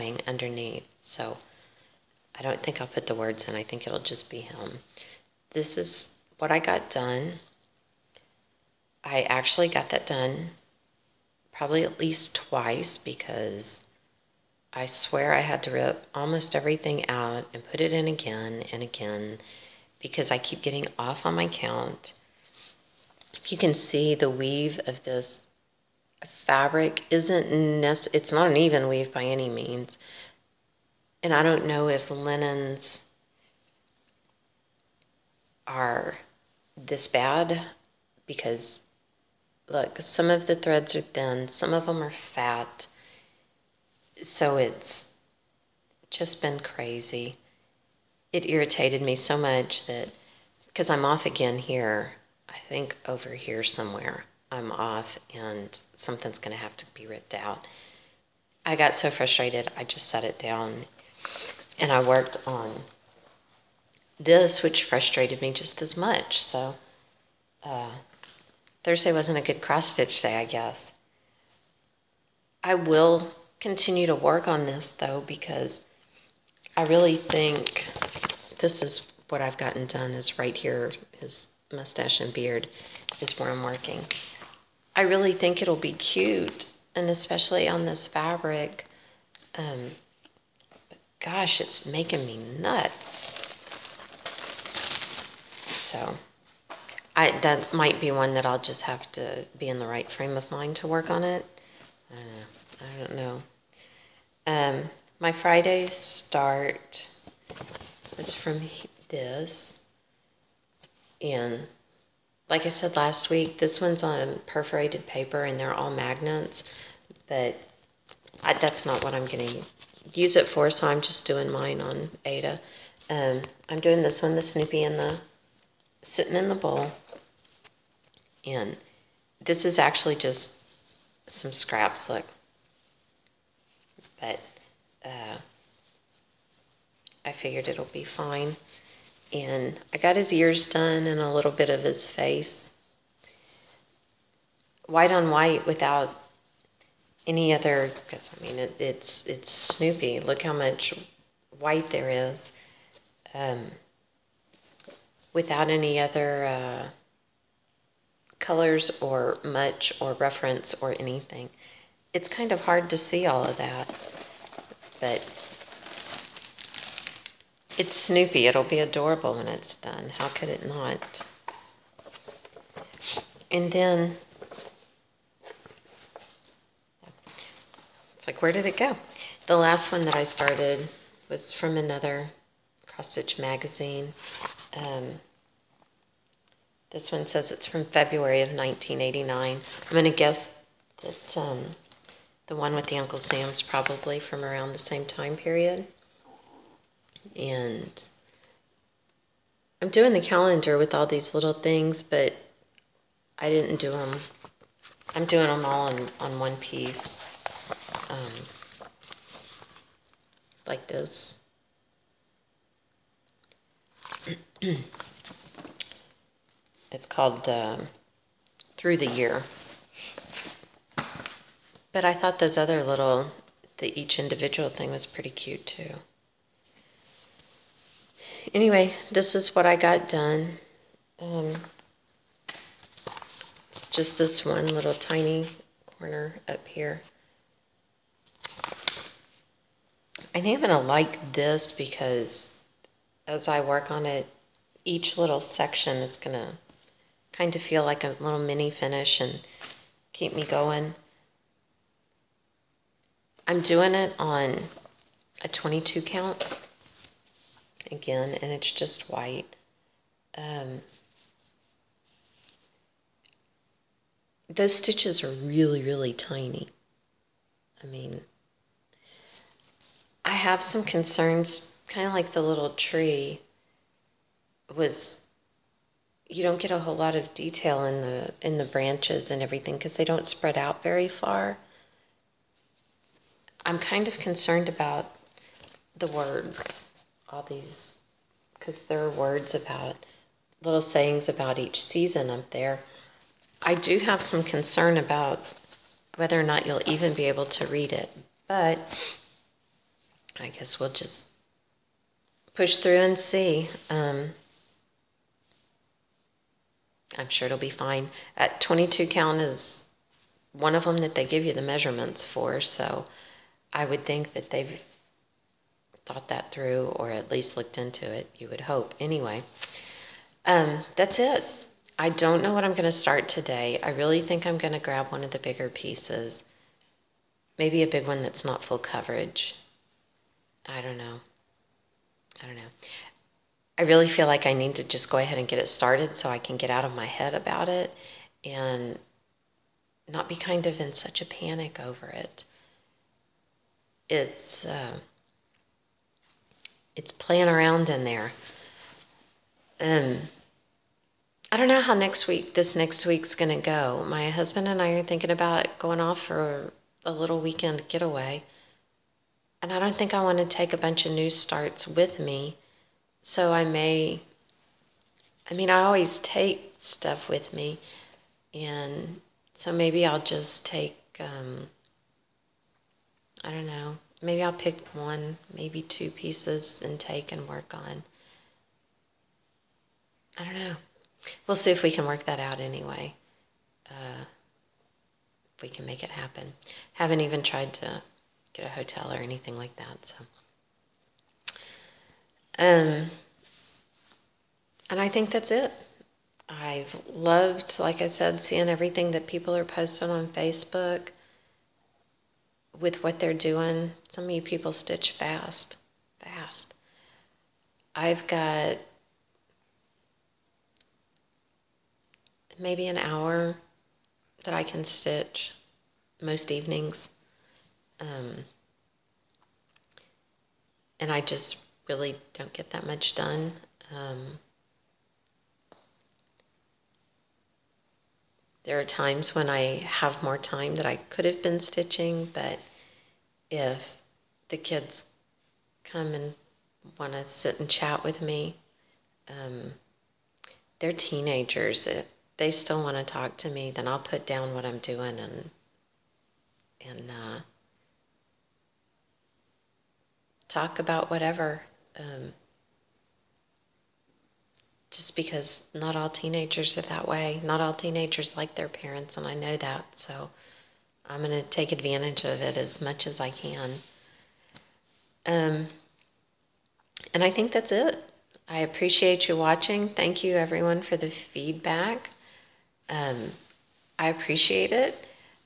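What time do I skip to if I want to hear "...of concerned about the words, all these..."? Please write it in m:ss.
4:44.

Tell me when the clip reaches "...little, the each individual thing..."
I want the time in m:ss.
3:42.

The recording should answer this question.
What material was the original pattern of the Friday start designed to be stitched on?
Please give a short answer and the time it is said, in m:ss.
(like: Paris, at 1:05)
Perforated paper, at 1:54.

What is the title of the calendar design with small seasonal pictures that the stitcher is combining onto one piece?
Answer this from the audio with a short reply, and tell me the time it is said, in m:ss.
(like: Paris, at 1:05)
Through the Year, at 3:38.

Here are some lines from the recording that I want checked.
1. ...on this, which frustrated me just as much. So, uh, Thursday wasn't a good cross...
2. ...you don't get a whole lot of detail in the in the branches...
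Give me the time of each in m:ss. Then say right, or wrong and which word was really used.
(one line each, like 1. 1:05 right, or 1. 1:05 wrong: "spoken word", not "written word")
1. 1:02 right
2. 4:36 right.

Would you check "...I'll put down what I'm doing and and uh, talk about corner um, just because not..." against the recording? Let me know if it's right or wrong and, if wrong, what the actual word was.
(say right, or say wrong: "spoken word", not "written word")
wrong: "whatever", not "corner".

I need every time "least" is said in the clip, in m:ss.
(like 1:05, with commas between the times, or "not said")
0:11, 5:17.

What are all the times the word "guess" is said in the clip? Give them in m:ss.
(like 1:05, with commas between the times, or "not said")
1:10, 3:10, 5:00.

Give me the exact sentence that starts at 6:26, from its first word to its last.
Haven't even tried to get a hotel or anything like that, so.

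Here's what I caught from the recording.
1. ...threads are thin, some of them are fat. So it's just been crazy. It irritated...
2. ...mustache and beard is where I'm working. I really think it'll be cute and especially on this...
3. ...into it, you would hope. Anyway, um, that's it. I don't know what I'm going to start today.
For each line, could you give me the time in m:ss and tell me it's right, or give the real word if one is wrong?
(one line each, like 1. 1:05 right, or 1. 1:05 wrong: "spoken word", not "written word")
1. 0:40 right
2. 1:21 right
3. 5:17 right.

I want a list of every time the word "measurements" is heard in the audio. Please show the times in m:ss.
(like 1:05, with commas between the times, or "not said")
5:11.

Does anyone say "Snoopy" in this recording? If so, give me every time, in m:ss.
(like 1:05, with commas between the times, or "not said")
2:04, 2:29, 2:47.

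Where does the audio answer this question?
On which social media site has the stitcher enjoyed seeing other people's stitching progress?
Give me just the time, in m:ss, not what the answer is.
6:40.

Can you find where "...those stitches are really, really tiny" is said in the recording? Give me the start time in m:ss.
4:24.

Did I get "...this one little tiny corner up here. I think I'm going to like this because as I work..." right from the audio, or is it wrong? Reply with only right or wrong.
right.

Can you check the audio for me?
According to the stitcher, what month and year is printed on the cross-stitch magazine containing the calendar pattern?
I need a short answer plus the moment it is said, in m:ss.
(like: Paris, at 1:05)
February 1989, at 3:07.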